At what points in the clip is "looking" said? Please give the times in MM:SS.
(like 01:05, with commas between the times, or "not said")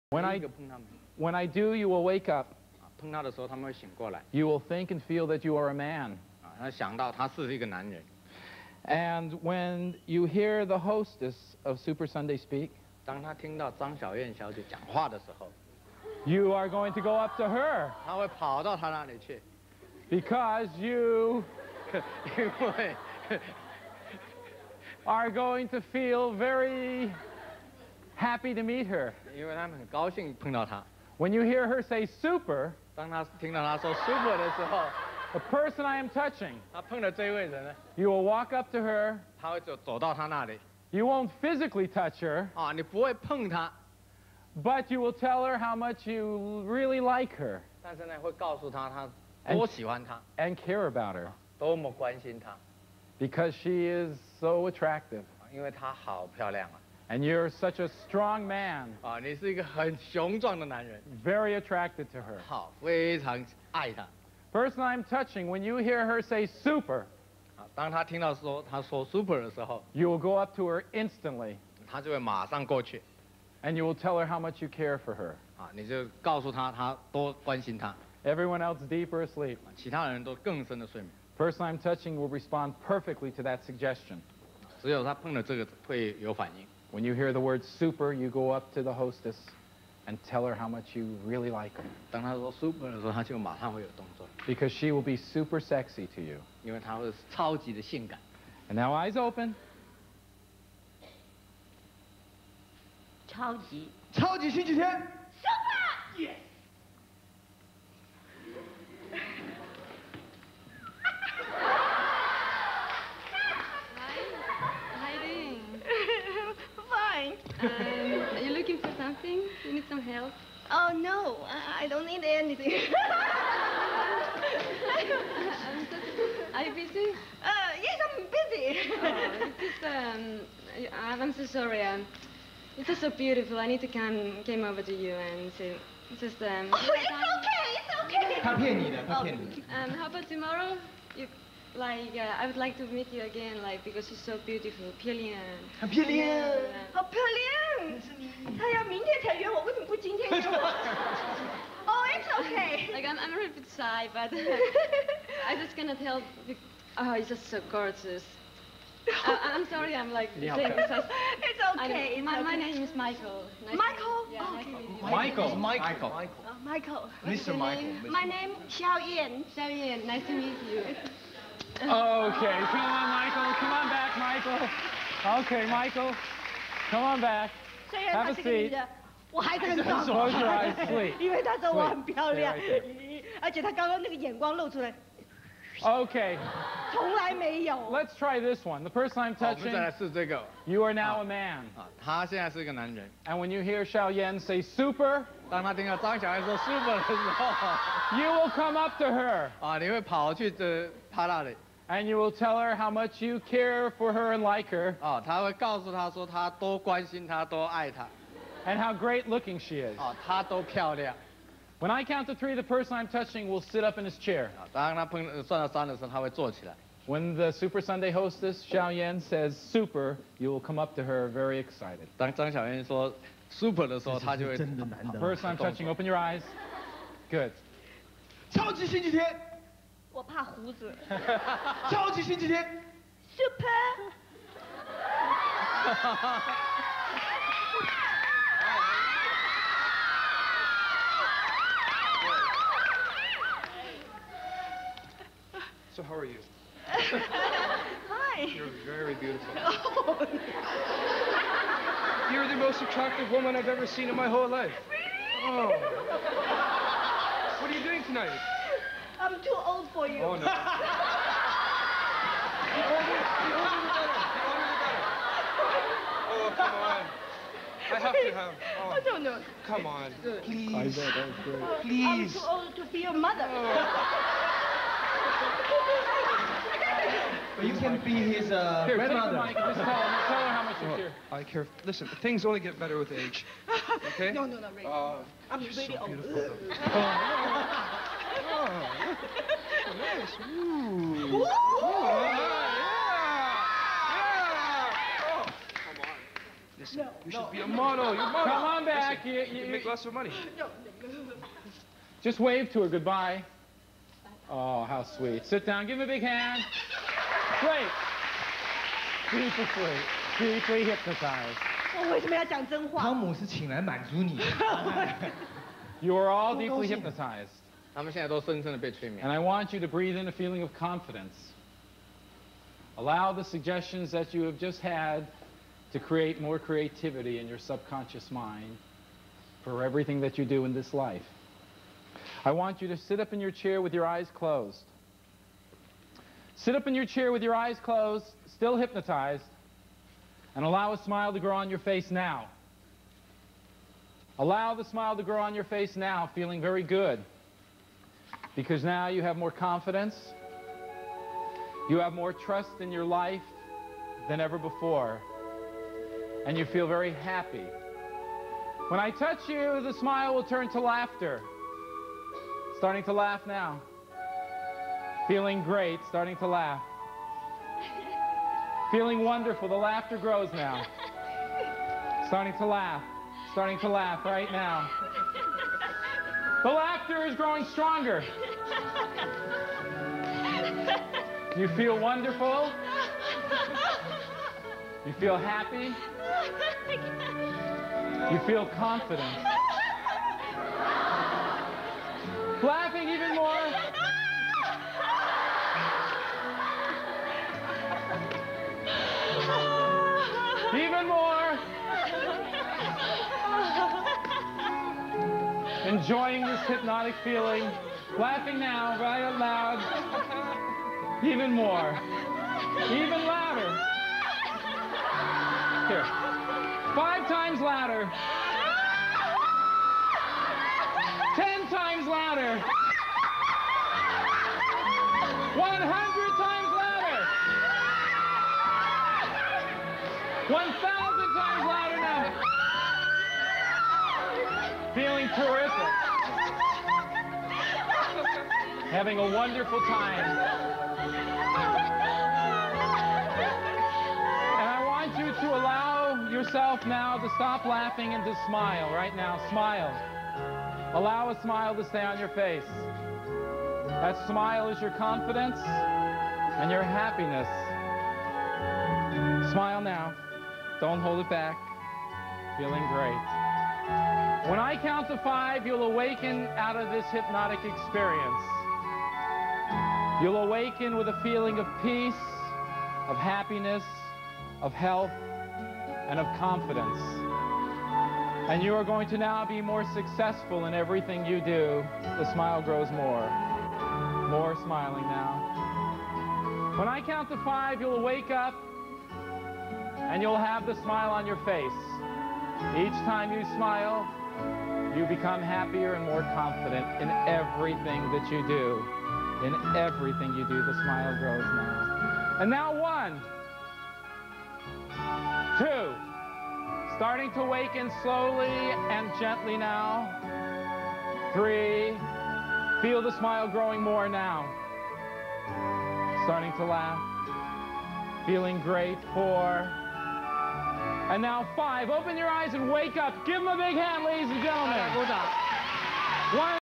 01:58, 03:29.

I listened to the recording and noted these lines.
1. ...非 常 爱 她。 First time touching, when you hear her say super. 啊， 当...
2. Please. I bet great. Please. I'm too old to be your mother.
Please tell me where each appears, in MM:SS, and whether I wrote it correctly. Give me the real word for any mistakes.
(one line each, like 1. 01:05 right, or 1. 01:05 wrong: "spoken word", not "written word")
1. 01:02 right
2. 04:30 right.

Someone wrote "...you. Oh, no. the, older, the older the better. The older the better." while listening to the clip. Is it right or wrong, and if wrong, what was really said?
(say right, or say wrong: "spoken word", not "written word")
right.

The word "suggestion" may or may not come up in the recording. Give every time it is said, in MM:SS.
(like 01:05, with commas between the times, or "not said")
01:23, 05:23.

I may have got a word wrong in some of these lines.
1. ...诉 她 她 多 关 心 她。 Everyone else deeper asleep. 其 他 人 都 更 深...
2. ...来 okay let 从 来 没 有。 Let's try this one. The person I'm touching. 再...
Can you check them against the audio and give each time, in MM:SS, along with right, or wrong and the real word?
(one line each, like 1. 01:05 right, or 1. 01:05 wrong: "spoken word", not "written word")
1. 01:16 right
2. 03:04 right.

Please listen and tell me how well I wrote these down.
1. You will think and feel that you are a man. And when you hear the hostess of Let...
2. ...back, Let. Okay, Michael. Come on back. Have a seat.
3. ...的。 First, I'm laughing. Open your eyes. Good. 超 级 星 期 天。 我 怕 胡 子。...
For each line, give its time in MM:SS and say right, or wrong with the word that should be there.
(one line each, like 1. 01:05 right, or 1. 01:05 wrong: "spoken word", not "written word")
1. 00:03 wrong: "Super", not "Let"
2. 02:53 wrong: "Michael", not "Let"
3. 03:45 wrong: "touching", not "laughing".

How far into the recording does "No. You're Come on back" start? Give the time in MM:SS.
04:58.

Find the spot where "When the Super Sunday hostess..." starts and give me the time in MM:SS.
03:37.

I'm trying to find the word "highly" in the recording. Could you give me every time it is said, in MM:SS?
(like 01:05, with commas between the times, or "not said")
not said.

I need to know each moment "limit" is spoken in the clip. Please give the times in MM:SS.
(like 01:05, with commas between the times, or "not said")
not said.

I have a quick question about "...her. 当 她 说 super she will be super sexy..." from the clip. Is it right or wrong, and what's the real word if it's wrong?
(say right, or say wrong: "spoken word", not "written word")
right.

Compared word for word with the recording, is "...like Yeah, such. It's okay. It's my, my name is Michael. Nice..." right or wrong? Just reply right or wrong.
right.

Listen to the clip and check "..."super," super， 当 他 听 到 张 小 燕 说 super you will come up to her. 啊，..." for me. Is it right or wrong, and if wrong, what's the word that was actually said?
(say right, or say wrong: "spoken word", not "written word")
right.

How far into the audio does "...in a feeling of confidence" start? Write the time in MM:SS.
05:20.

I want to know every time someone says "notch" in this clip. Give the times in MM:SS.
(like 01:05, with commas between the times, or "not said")
not said.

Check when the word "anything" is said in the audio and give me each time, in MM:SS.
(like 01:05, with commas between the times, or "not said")
02:02.